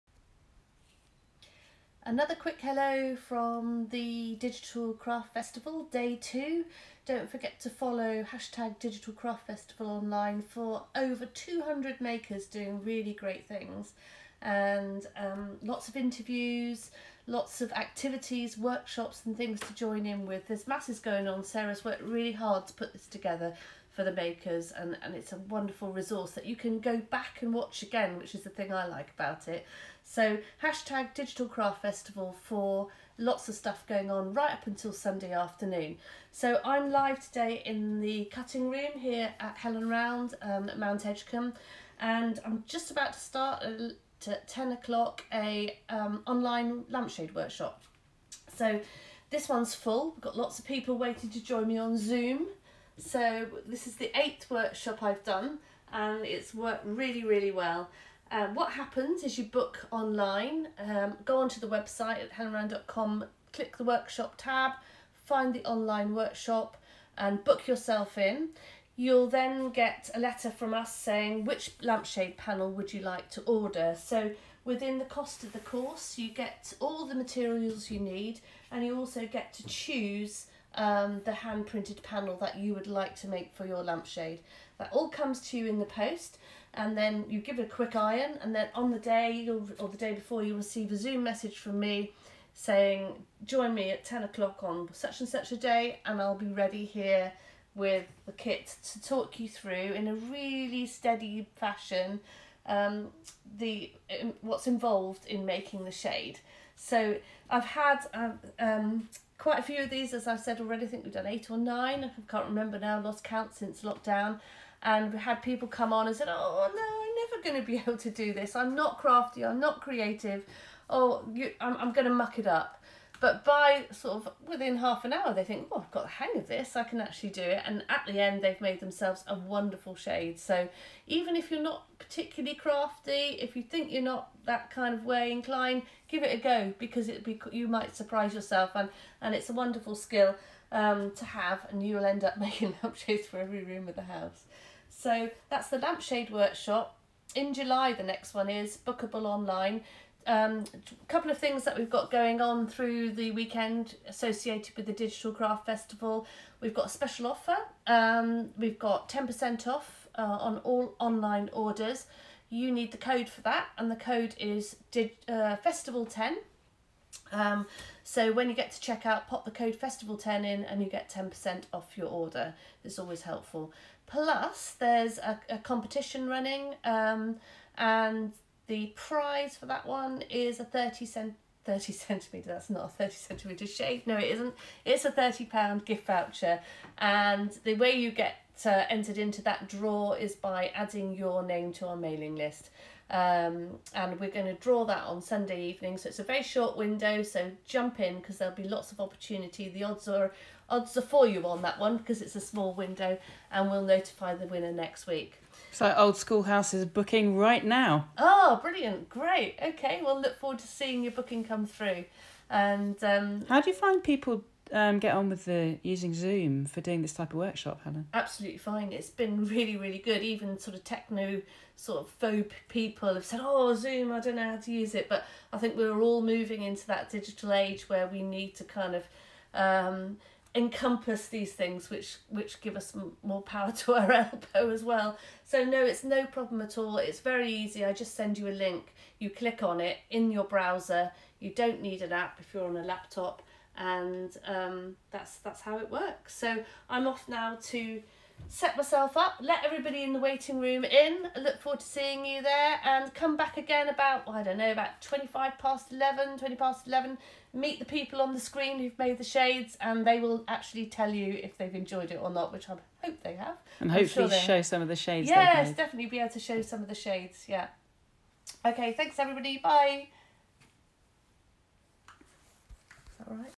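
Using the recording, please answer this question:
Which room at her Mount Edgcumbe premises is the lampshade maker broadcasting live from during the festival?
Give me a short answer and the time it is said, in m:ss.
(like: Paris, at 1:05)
the cutting room, at 0:38.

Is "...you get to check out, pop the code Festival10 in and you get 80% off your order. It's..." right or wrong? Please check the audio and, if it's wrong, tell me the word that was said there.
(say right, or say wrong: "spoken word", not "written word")
wrong: "10", not "80".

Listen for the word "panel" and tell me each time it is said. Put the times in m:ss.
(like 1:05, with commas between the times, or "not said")
1:12, 1:22.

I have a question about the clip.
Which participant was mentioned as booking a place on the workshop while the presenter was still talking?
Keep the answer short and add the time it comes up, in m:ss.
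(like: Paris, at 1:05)
Old Schoolhouse, at 3:25.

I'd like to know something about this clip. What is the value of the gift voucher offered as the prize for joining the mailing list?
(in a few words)
£30.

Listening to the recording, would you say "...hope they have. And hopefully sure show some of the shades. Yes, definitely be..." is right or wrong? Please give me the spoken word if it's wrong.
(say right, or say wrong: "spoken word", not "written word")
right.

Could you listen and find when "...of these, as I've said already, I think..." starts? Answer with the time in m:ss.
1:49.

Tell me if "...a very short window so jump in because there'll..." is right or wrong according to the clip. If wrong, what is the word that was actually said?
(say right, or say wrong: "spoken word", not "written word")
right.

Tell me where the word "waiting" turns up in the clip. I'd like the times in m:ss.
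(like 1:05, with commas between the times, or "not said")
0:50, 4:10.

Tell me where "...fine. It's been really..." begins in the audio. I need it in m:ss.
3:38.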